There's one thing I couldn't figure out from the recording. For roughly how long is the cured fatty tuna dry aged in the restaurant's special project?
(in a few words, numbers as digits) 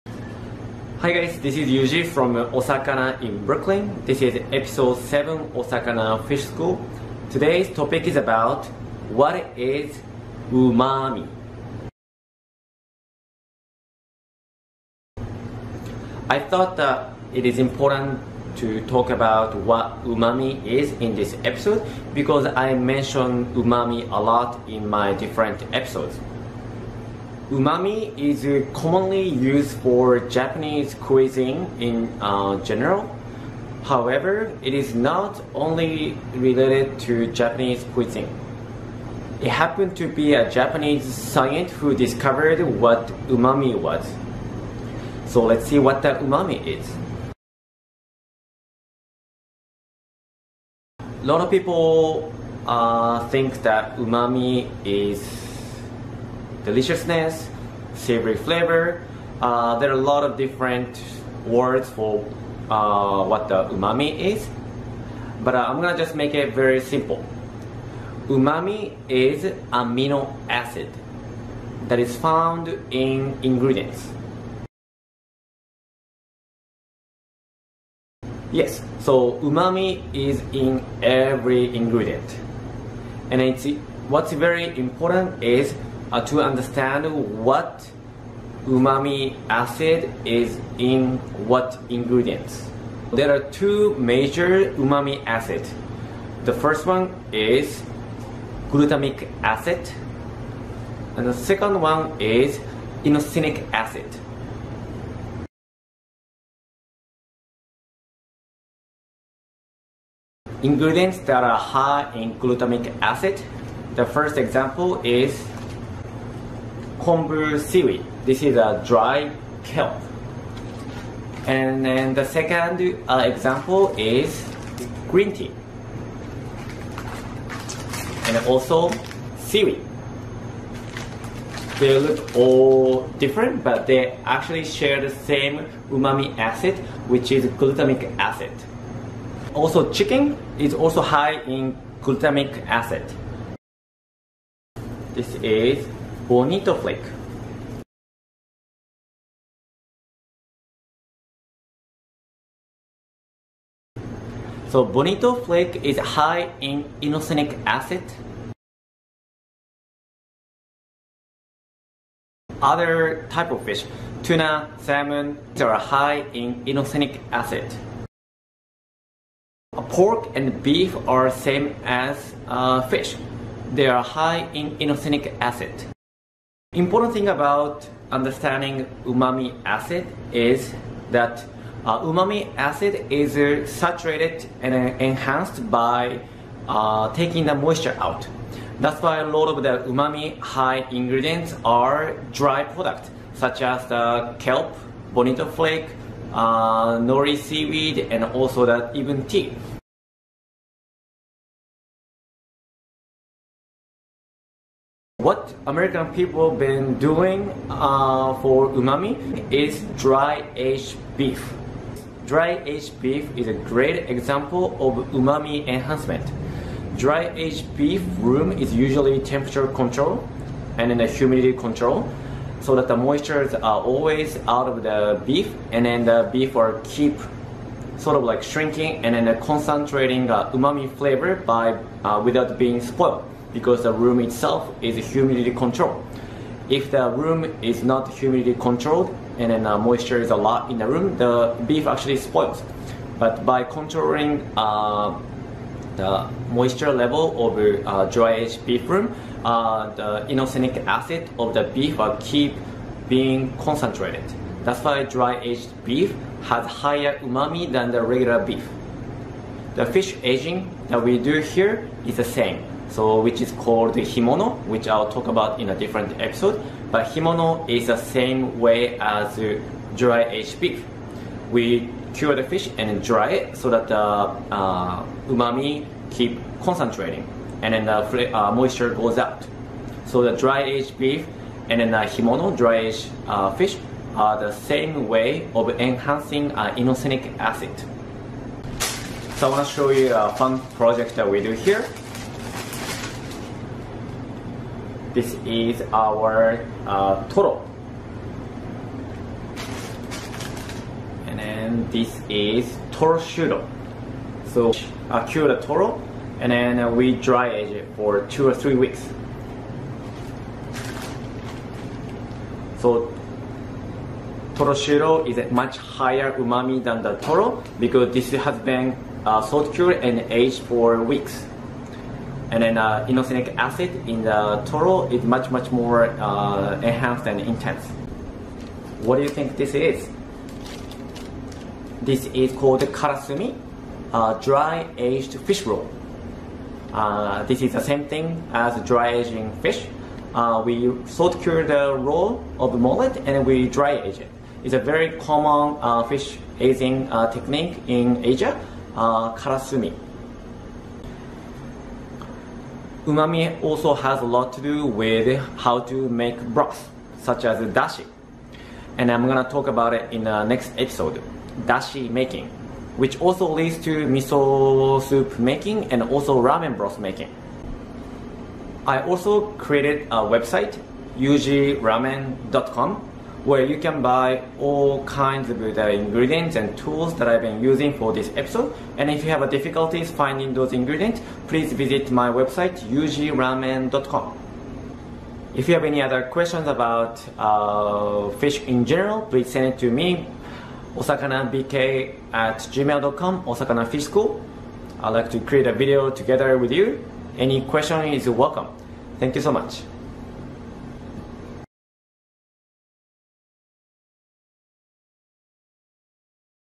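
2 or 3 weeks.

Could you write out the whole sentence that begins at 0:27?
Umami is uh, commonly used for Japanese cuisine in uh, general.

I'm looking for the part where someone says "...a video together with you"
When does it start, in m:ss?
6:35.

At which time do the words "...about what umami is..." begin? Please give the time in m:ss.
0:19.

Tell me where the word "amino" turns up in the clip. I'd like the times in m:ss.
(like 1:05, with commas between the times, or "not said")
1:09.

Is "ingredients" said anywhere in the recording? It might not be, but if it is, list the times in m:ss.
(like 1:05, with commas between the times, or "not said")
1:13, 1:21, 1:31, 1:50, 3:10, 6:15, 6:20.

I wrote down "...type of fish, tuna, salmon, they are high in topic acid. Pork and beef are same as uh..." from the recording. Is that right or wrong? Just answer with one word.
wrong.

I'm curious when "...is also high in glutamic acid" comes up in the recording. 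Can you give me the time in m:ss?
2:20.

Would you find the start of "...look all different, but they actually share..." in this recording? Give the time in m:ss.
2:11.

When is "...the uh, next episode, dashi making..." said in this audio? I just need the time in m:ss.
6:00.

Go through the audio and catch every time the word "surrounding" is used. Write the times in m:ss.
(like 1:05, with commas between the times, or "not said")
not said.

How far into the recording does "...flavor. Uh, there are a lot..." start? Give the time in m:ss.
0:58.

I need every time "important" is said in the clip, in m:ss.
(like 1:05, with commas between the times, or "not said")
0:17, 1:24, 2:56.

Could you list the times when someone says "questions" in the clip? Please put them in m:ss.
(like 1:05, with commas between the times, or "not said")
6:26, 6:37.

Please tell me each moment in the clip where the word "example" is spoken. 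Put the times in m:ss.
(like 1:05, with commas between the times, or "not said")
1:54, 2:03, 3:34.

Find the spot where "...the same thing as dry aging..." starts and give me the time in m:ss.
5:37.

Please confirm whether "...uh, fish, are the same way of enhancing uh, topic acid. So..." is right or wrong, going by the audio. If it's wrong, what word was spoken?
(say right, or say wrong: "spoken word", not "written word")
wrong: "inosinic", not "topic".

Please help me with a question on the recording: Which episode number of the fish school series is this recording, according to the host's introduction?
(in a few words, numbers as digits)
7.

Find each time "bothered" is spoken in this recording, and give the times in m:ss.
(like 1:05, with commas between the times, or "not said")
not said.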